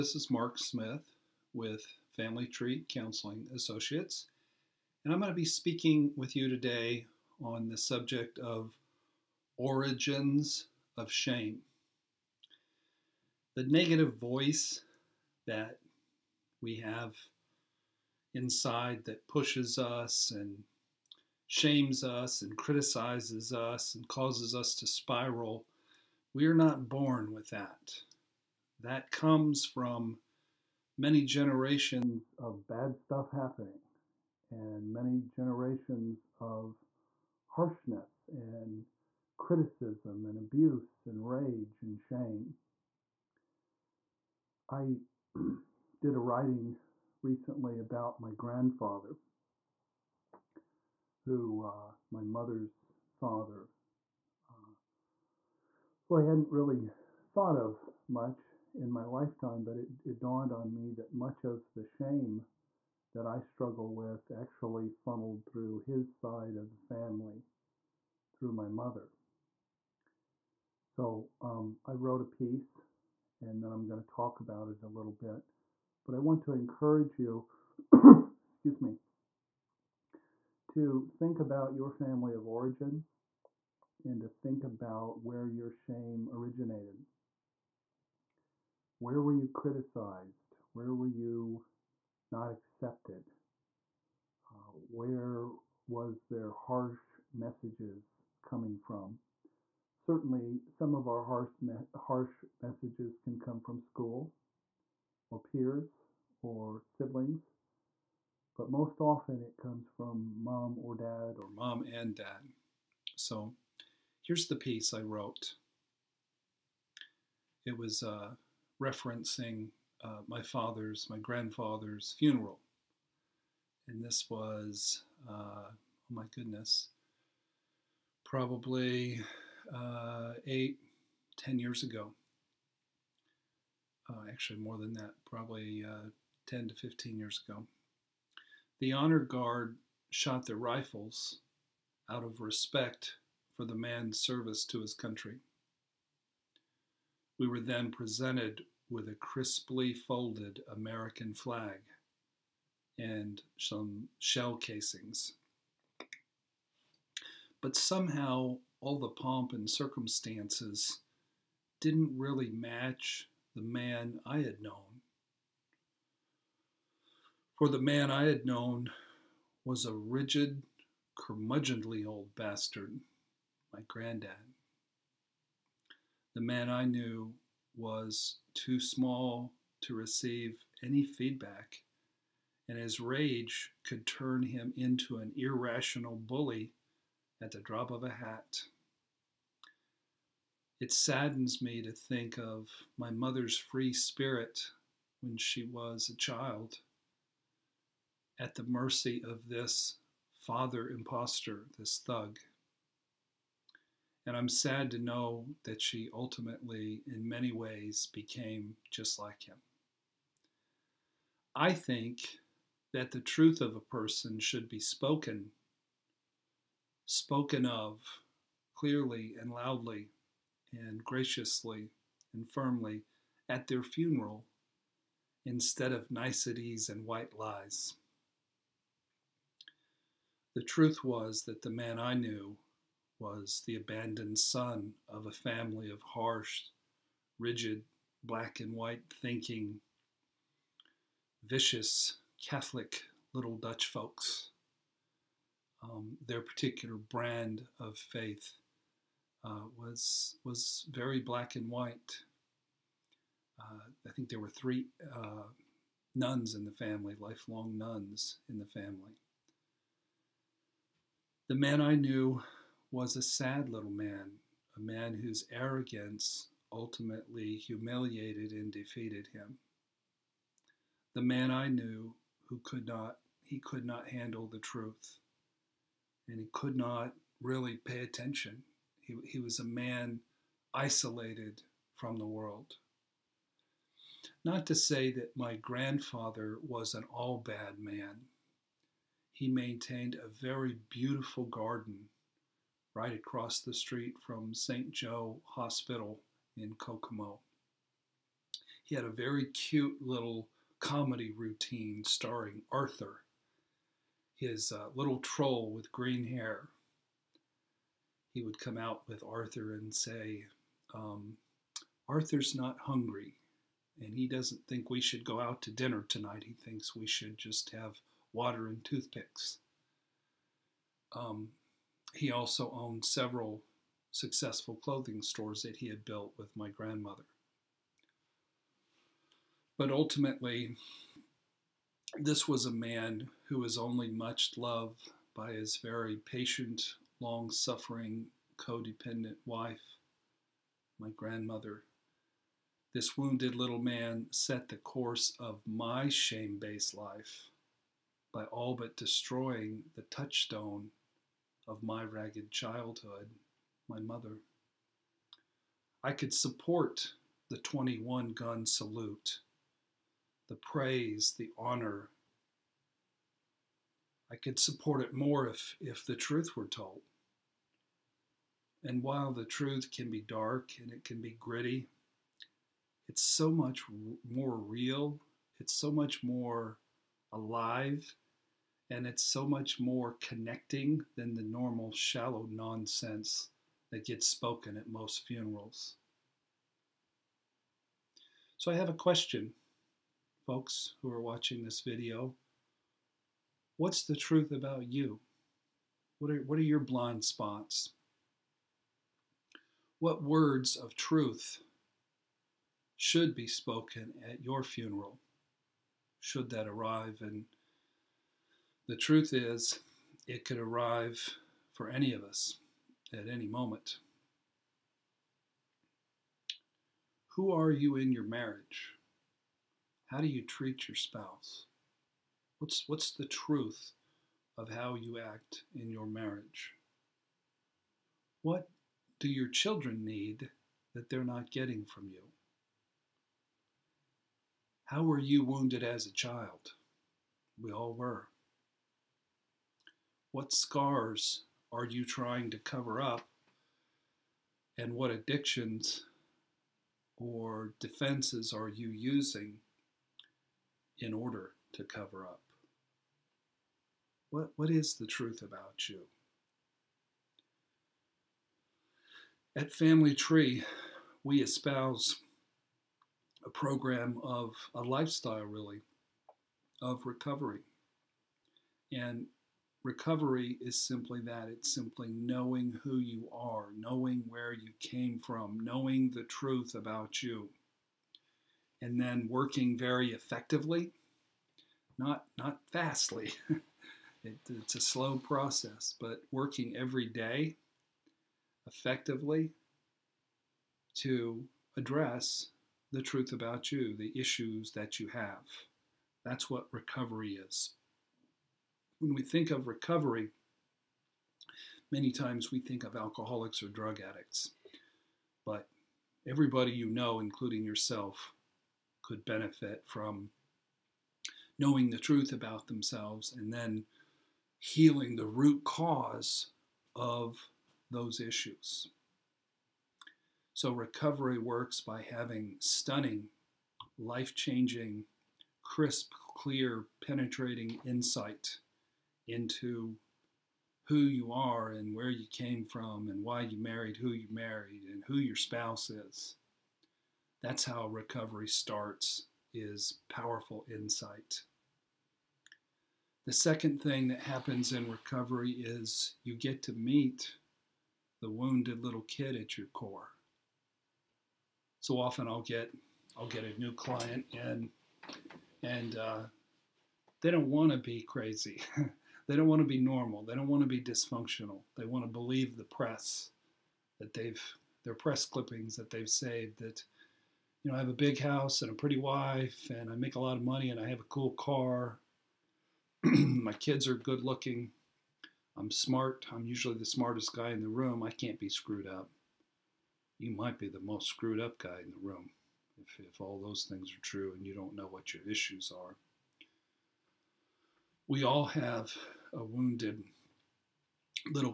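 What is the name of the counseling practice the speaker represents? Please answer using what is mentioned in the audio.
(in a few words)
Family Tree Counseling Associates.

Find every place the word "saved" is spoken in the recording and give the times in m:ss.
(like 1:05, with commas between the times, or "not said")
9:26.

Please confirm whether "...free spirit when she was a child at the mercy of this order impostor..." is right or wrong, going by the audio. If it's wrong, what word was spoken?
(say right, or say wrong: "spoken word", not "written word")
wrong: "father", not "order".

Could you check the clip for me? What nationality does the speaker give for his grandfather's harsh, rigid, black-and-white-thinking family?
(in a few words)
Dutch.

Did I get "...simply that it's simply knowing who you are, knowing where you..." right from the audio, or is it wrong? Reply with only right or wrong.
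right.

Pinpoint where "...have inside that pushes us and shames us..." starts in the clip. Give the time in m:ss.
0:16.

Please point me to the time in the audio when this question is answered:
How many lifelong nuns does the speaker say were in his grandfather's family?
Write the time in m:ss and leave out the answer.
4:14.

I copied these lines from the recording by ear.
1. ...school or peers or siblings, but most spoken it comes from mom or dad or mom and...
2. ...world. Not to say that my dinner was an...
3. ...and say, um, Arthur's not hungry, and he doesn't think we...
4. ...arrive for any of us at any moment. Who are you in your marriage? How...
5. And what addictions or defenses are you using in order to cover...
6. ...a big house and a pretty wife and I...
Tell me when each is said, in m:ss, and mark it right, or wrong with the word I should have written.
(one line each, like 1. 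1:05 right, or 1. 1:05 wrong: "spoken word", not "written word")
1. 1:43 wrong: "often", not "spoken"
2. 4:42 wrong: "grandfather", not "dinner"
3. 5:09 right
4. 6:50 right
5. 7:24 right
6. 9:27 right.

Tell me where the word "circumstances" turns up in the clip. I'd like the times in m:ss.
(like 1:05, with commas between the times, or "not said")
2:39.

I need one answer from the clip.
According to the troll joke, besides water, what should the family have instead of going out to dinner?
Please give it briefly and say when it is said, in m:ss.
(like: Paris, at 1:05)
Toothpicks, at 5:18.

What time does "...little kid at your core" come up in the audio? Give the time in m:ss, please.
9:08.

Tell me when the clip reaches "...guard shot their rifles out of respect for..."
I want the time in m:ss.
2:19.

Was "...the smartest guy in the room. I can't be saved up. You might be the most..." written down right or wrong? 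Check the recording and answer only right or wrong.
wrong.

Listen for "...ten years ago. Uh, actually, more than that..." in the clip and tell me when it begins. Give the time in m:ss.
2:11.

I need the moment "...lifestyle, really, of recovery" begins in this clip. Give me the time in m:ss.
7:44.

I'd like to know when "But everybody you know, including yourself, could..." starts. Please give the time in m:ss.
8:25.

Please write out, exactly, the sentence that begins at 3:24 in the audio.
And I'm sad to know that she ultimately, in many ways, became just like him.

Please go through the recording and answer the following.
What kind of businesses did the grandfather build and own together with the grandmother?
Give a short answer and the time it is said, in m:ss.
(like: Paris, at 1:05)
Clothing stores, at 5:24.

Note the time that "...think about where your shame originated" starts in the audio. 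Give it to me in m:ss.
1:24.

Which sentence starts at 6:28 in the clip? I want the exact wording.
So I have a question, folks who are watching this video.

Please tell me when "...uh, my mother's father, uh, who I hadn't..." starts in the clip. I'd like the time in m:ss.
0:51.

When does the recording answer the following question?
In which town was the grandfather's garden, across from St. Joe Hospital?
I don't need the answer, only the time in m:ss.
4:56.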